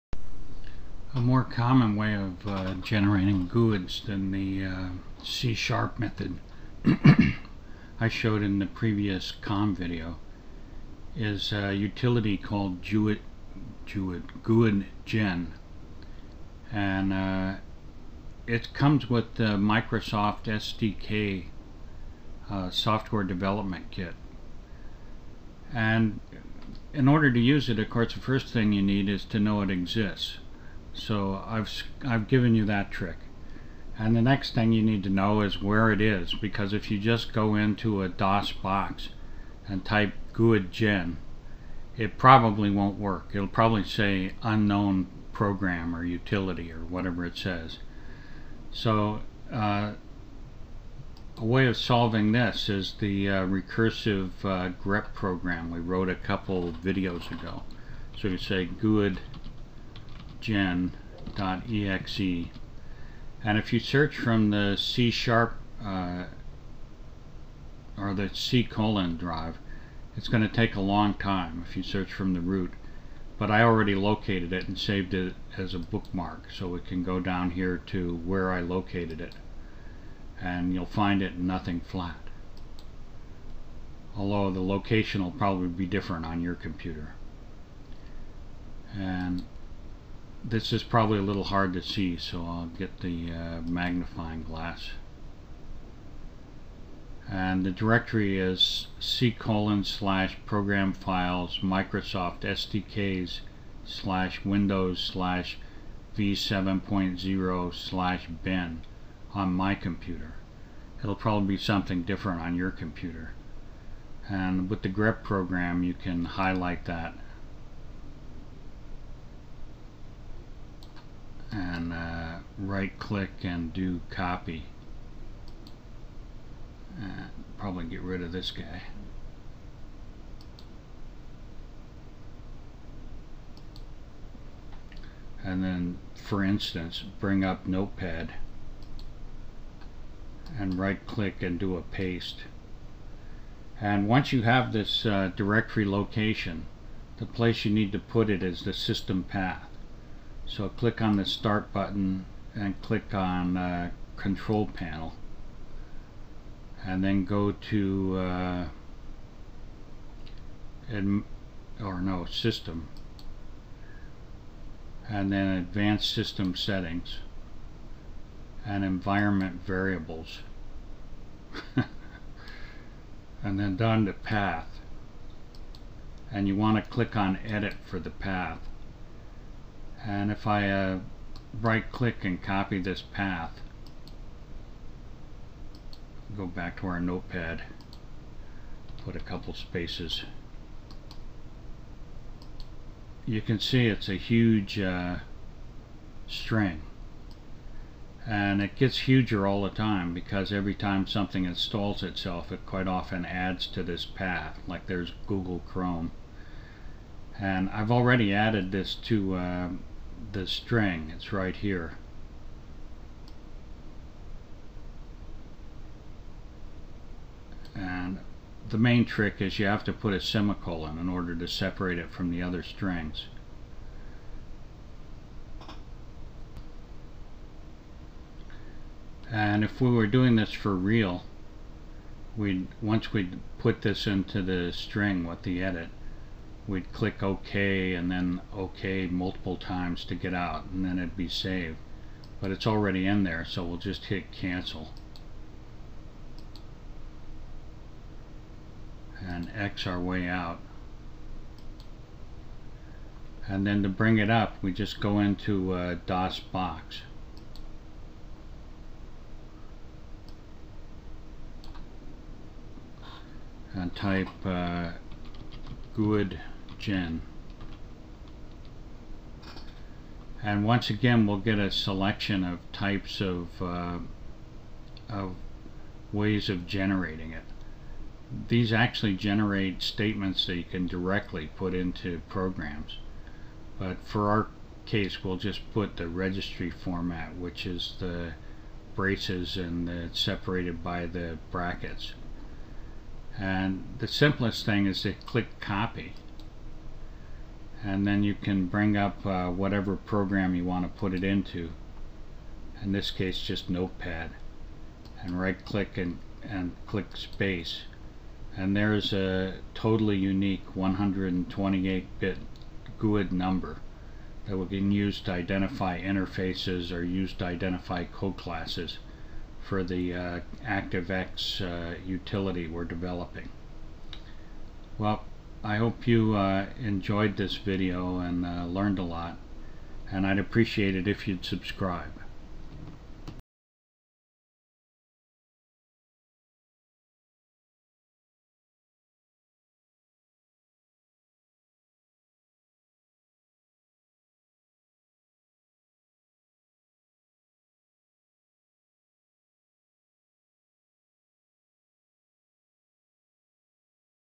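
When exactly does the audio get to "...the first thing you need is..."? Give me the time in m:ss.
0:28.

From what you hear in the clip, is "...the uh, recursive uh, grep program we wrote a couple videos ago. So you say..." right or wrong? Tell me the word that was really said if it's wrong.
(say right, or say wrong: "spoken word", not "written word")
right.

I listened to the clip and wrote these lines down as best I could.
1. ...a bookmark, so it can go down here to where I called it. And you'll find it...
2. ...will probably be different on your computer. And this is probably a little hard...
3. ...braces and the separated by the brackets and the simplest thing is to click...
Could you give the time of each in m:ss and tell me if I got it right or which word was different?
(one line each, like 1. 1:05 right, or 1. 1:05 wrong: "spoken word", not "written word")
1. 1:15 wrong: "located", not "called"
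2. 1:25 right
3. 4:48 right.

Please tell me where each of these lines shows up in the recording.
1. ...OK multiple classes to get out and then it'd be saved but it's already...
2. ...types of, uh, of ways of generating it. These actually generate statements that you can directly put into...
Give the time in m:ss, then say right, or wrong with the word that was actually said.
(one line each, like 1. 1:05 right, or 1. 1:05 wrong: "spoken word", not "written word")
1. 3:58 wrong: "times", not "classes"
2. 4:32 right.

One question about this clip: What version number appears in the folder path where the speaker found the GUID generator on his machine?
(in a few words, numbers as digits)
v7.0.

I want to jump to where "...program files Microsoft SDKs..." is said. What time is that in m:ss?
1:40.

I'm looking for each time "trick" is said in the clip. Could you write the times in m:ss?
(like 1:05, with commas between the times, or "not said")
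0:32, 3:39.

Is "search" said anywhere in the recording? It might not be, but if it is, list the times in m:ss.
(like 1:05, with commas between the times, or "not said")
1:03, 1:11.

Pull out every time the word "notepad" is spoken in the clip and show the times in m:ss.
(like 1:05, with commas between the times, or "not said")
2:17, 3:06, 5:03.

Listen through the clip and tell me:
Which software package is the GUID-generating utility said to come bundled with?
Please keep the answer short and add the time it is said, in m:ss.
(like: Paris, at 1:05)
Microsoft SDK, at 0:19.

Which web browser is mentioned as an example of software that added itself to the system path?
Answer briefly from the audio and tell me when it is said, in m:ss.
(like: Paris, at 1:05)
Google Chrome, at 3:25.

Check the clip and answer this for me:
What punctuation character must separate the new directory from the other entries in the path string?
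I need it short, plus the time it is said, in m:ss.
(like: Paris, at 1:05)
semicolon, at 3:40.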